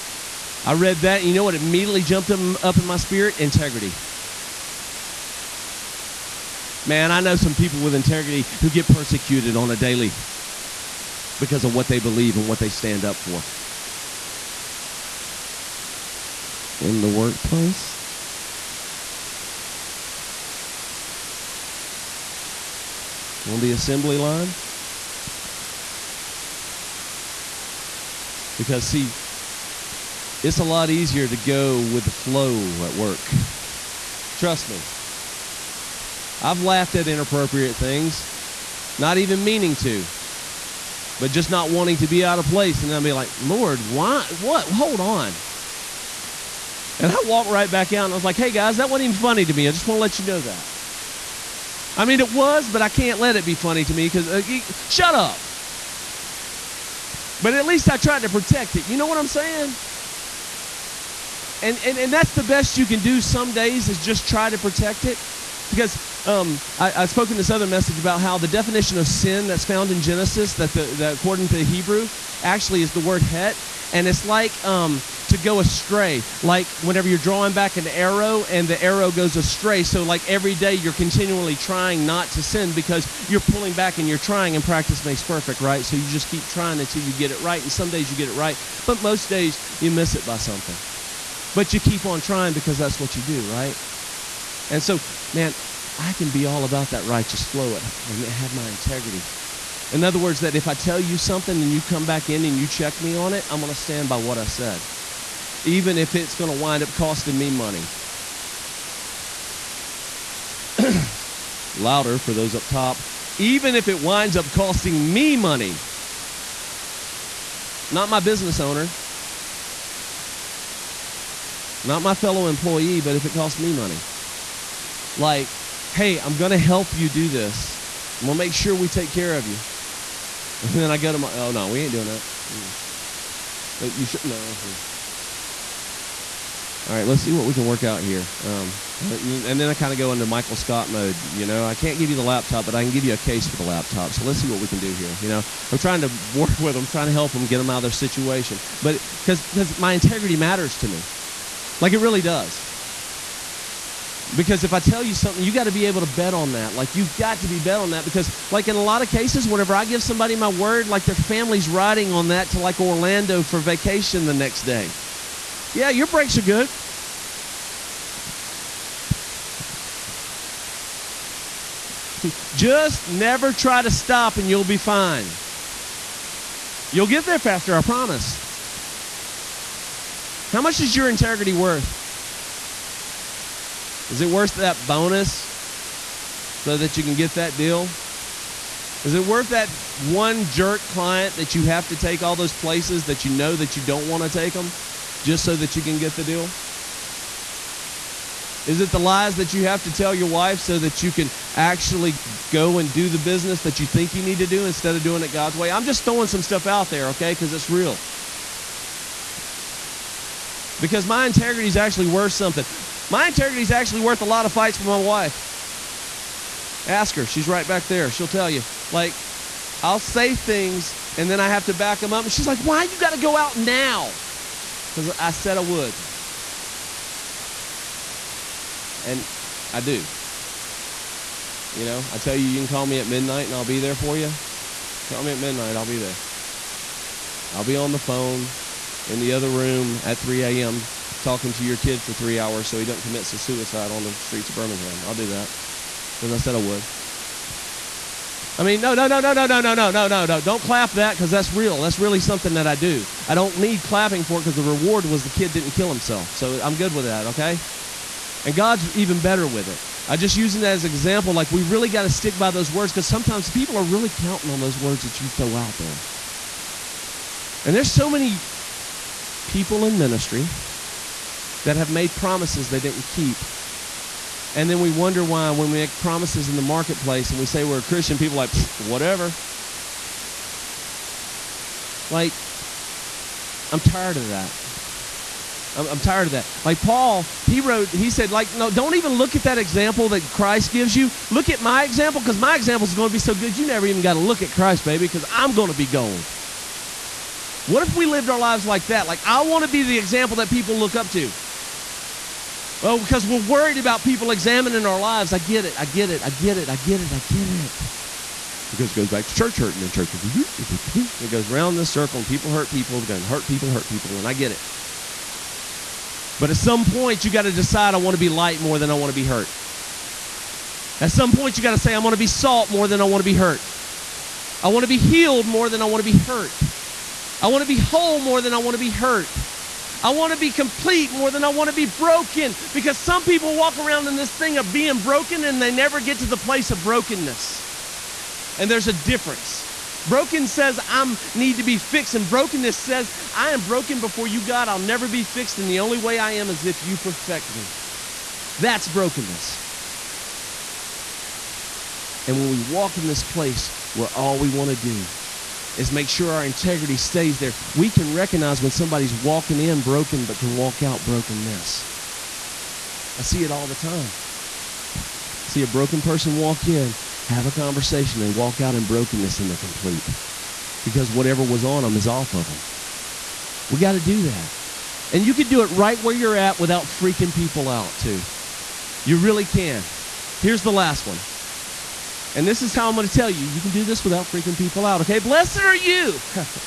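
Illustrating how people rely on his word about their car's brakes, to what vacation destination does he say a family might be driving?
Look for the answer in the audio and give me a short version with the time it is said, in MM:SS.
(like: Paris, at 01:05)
Orlando, at 02:42.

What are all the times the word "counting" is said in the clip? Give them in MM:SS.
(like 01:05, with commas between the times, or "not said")
04:24.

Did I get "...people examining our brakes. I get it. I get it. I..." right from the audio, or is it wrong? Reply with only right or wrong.
wrong.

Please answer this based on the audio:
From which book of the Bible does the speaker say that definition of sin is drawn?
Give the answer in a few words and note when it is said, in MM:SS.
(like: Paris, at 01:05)
Genesis, at 01:09.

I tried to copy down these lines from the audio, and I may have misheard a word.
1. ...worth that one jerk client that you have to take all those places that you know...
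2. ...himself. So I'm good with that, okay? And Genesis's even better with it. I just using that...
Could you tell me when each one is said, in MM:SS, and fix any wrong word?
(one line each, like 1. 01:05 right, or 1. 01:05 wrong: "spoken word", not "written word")
1. 03:09 right
2. 04:15 wrong: "God", not "Genesis".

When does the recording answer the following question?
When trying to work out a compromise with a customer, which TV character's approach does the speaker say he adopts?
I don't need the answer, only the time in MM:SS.
02:20.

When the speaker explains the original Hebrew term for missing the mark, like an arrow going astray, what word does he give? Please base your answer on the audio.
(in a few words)
het.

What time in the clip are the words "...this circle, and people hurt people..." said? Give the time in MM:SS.
05:11.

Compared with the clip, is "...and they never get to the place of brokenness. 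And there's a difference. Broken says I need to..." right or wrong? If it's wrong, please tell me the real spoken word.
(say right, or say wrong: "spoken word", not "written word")
right.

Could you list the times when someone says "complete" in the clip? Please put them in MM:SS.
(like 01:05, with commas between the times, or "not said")
05:30, 06:09.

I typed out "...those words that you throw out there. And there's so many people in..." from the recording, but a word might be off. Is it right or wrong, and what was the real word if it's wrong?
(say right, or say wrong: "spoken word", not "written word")
right.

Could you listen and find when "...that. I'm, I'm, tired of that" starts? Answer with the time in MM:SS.
04:44.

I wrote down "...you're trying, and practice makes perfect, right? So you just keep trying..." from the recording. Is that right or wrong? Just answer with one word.
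right.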